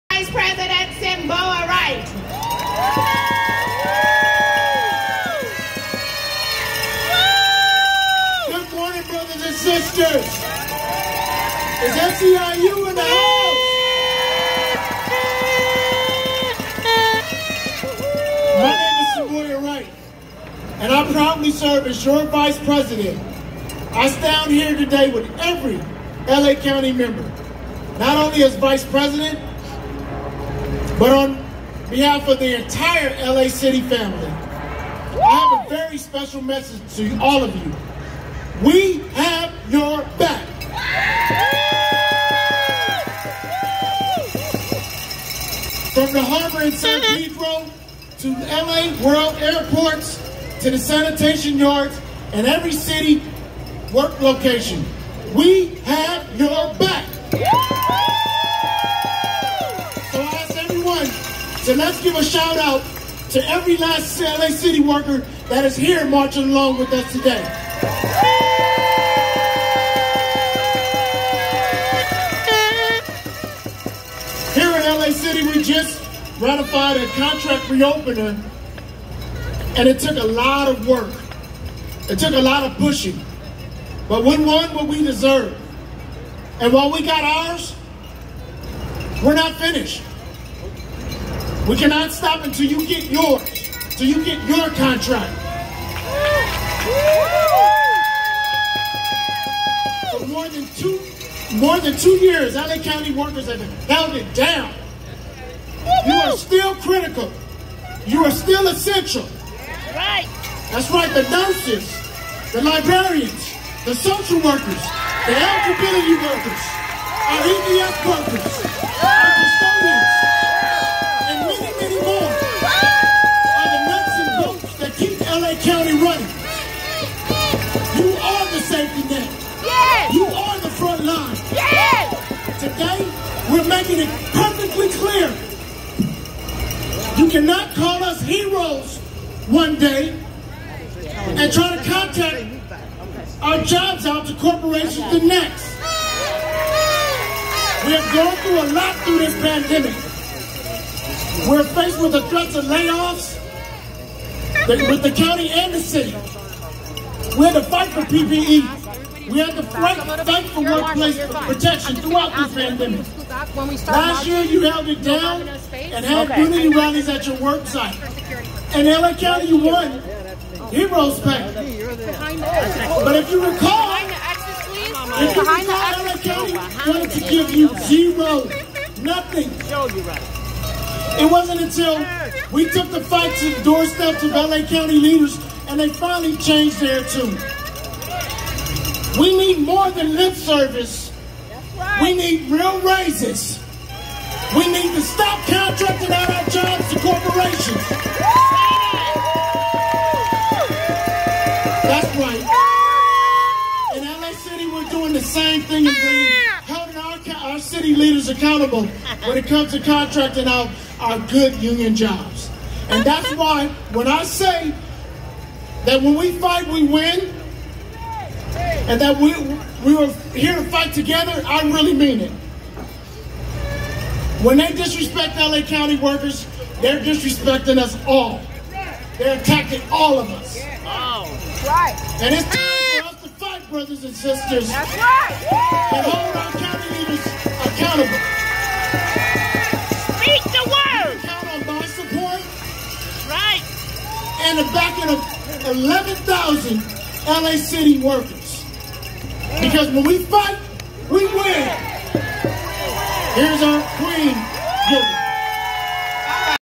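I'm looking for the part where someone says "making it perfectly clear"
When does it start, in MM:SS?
02:13.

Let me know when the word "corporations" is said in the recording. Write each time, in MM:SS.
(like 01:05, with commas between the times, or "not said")
02:24, 03:16.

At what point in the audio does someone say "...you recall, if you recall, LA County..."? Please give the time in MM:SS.
02:53.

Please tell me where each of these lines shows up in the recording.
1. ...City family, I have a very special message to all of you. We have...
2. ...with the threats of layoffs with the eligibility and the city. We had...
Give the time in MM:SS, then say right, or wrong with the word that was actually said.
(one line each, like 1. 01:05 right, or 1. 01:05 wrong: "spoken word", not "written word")
1. 00:33 right
2. 02:32 wrong: "county", not "eligibility".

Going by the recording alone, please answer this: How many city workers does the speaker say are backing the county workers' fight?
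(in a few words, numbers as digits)
11,000.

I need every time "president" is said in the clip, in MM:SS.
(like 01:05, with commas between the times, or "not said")
00:00, 00:22, 00:28.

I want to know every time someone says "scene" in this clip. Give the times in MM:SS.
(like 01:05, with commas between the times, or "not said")
not said.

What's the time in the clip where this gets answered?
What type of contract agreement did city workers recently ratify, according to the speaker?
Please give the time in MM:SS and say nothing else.
01:17.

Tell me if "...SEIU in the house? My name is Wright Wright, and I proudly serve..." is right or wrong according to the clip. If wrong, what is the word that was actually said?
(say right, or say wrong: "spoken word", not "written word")
wrong: "Simboa", not "Wright".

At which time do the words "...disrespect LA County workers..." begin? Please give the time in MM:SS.
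03:44.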